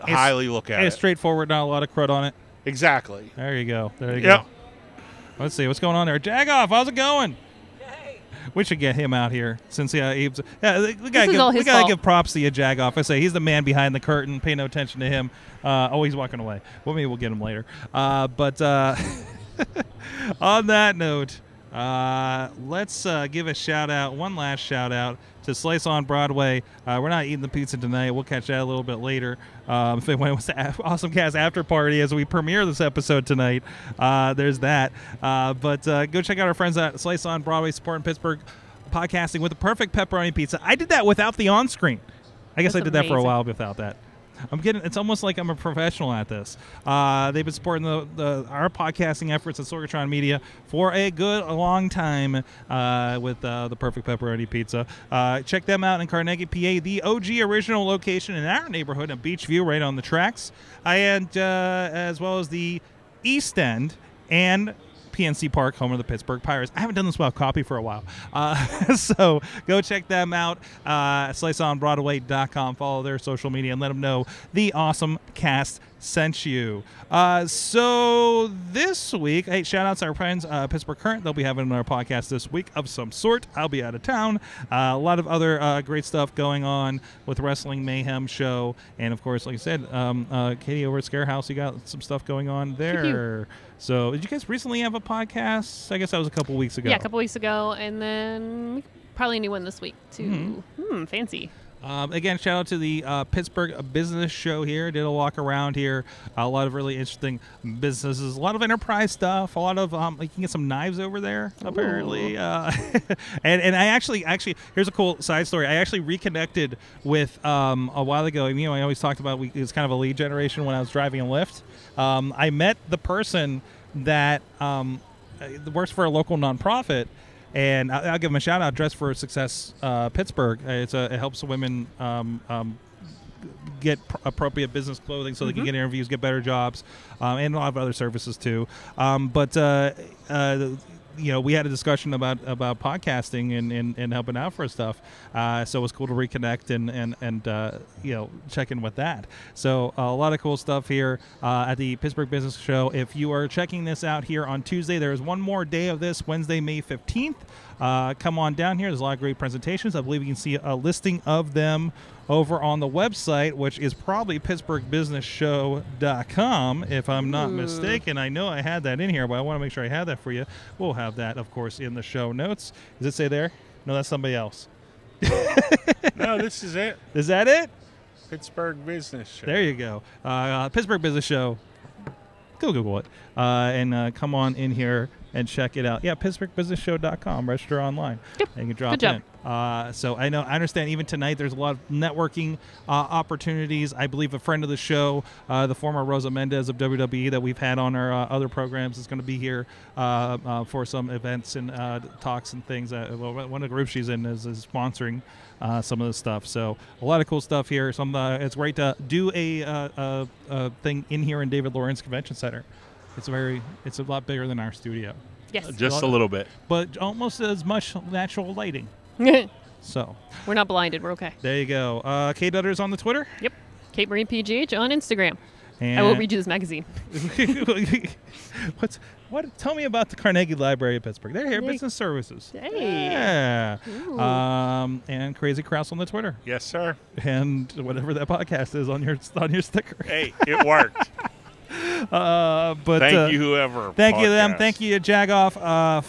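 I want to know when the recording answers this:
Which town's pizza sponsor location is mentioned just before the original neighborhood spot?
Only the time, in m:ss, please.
0:56.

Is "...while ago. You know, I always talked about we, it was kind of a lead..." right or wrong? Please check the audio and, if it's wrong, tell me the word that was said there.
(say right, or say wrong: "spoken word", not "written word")
right.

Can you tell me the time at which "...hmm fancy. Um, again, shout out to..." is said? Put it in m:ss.
1:40.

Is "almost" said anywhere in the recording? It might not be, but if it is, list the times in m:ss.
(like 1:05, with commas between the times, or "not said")
0:44, 3:36.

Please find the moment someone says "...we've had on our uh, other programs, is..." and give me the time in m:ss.
3:17.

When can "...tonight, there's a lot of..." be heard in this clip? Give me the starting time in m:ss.
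3:11.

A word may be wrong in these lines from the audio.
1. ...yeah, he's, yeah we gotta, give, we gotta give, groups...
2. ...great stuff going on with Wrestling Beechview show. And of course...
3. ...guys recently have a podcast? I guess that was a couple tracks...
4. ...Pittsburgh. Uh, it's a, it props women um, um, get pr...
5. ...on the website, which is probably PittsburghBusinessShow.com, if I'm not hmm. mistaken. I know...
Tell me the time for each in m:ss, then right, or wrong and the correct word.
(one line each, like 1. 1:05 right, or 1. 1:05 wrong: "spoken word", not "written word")
1. 0:09 wrong: "props", not "groups"
2. 1:25 wrong: "Mayhem", not "Beechview"
3. 1:34 wrong: "weeks", not "tracks"
4. 2:10 wrong: "helps", not "props"
5. 2:42 right.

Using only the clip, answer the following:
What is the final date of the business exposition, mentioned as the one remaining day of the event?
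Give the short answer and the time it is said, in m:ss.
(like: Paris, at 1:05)
Wednesday, May 15, at 2:36.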